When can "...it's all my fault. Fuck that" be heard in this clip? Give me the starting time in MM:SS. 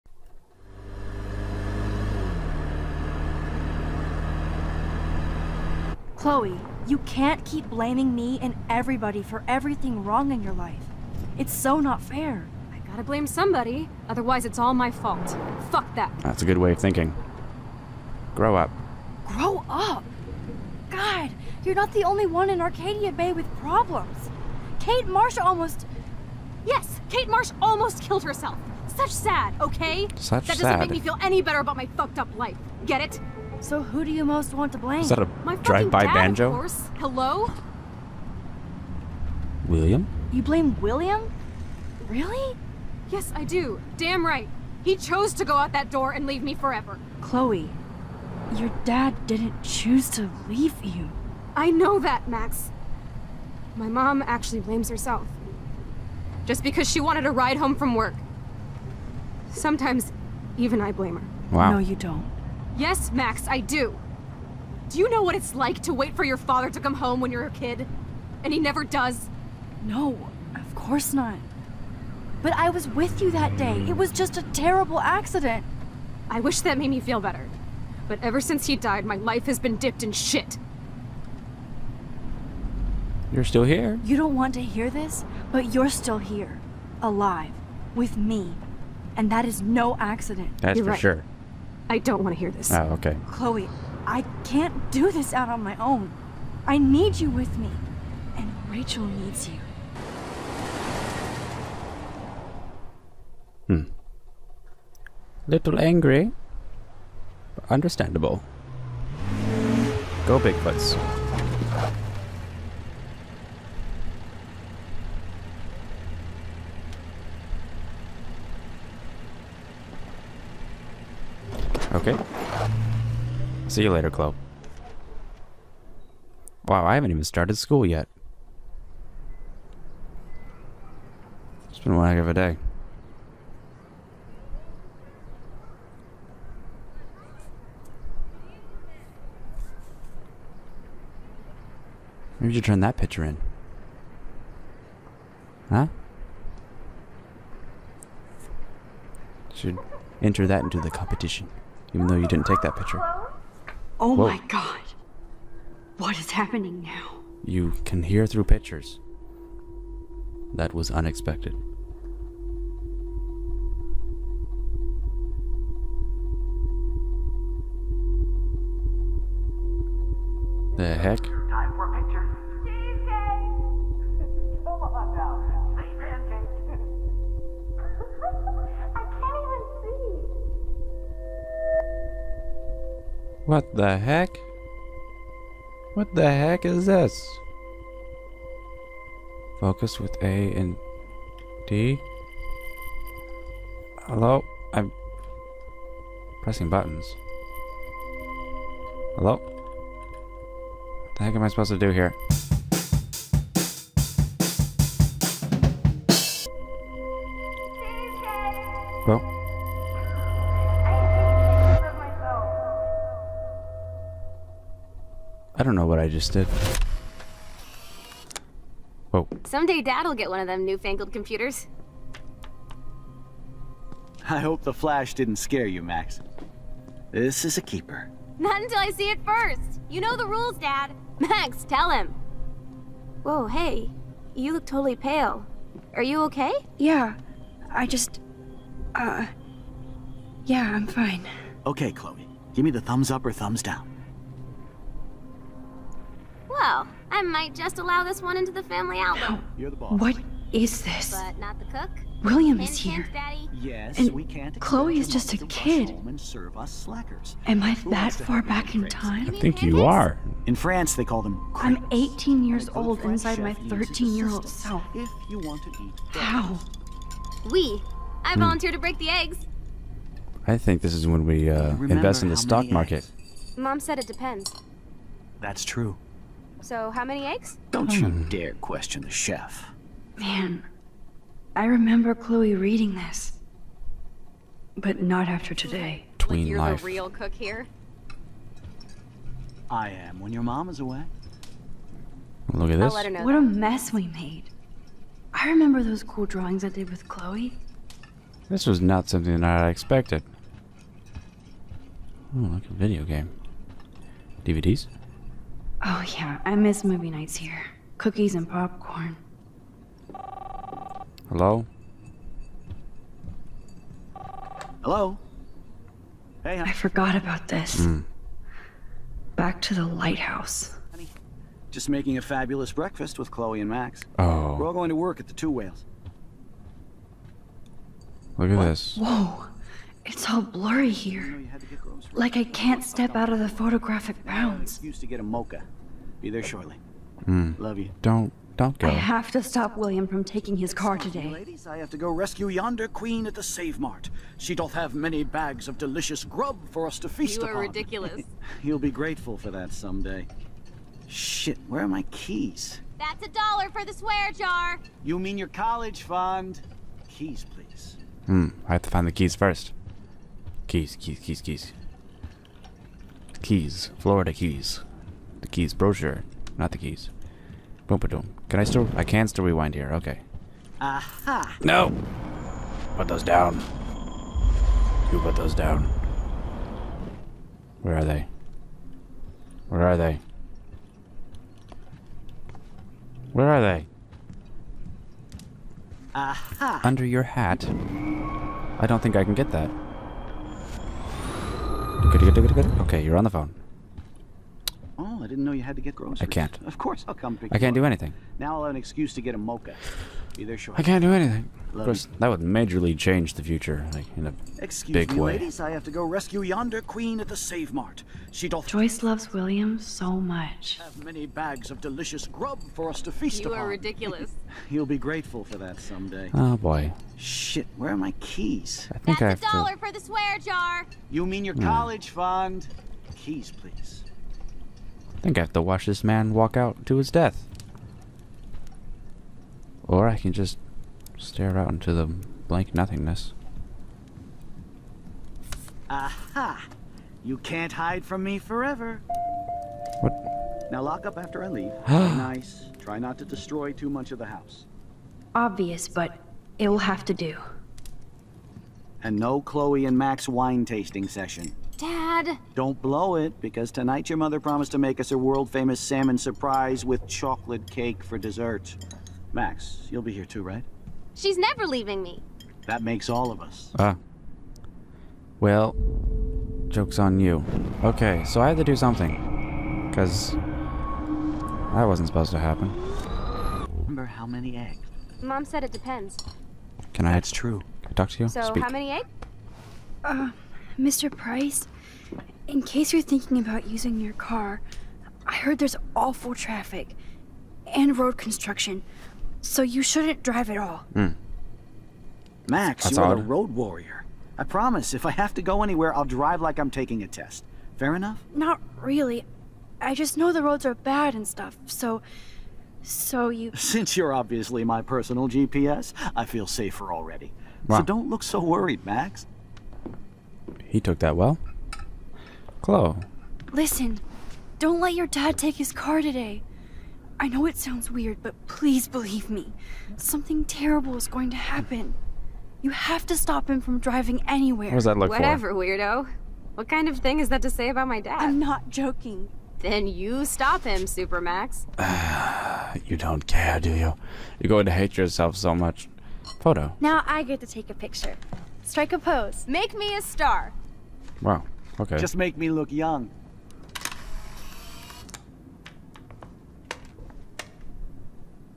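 00:14.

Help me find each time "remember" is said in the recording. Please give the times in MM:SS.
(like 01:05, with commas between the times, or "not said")
04:41, 04:55, 07:53.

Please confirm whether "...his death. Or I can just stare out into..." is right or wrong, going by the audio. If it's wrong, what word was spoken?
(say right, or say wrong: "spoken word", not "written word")
right.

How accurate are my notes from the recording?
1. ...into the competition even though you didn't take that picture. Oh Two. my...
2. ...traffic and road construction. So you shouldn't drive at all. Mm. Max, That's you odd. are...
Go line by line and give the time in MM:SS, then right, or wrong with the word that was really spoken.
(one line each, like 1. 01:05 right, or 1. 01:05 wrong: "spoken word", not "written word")
1. 02:30 wrong: "Whoa", not "Two"
2. 08:06 right.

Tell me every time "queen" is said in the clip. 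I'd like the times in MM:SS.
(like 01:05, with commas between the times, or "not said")
05:42, 06:46.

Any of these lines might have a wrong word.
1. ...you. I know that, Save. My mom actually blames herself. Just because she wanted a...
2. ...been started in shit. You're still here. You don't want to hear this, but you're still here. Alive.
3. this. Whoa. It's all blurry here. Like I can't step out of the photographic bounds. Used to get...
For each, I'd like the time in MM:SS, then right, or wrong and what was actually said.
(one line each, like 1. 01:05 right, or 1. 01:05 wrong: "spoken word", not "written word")
1. 00:50 wrong: "Max", not "Save"
2. 01:19 wrong: "dipped", not "started"
3. 05:28 right.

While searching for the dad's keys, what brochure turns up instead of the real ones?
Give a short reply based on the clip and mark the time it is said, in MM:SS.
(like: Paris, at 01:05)
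Florida Keys, at 06:03.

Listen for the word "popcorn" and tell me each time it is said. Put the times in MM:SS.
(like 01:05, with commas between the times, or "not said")
05:08.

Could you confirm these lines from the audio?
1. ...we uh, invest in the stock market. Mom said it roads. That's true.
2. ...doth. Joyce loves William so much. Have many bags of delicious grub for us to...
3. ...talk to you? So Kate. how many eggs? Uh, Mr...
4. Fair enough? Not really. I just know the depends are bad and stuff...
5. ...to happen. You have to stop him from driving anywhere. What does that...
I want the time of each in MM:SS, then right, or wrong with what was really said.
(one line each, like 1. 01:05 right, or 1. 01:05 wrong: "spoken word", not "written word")
1. 04:31 wrong: "depends", not "roads"
2. 06:48 right
3. 07:57 wrong: "Speak", not "Kate"
4. 08:17 wrong: "roads", not "depends"
5. 08:41 right.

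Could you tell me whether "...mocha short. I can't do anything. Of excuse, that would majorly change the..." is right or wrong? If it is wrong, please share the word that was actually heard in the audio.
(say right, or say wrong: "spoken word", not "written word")
wrong: "course", not "excuse".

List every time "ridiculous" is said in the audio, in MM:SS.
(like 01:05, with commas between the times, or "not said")
05:47, 06:53.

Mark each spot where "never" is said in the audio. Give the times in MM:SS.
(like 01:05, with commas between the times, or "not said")
01:08, 07:41.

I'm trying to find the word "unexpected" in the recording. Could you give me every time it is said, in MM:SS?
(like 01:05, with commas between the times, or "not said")
02:40.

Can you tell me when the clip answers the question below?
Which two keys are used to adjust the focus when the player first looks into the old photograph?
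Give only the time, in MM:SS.
03:10.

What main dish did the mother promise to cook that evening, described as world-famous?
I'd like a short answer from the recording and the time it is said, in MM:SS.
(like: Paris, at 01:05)
Salmon surprise, at 07:35.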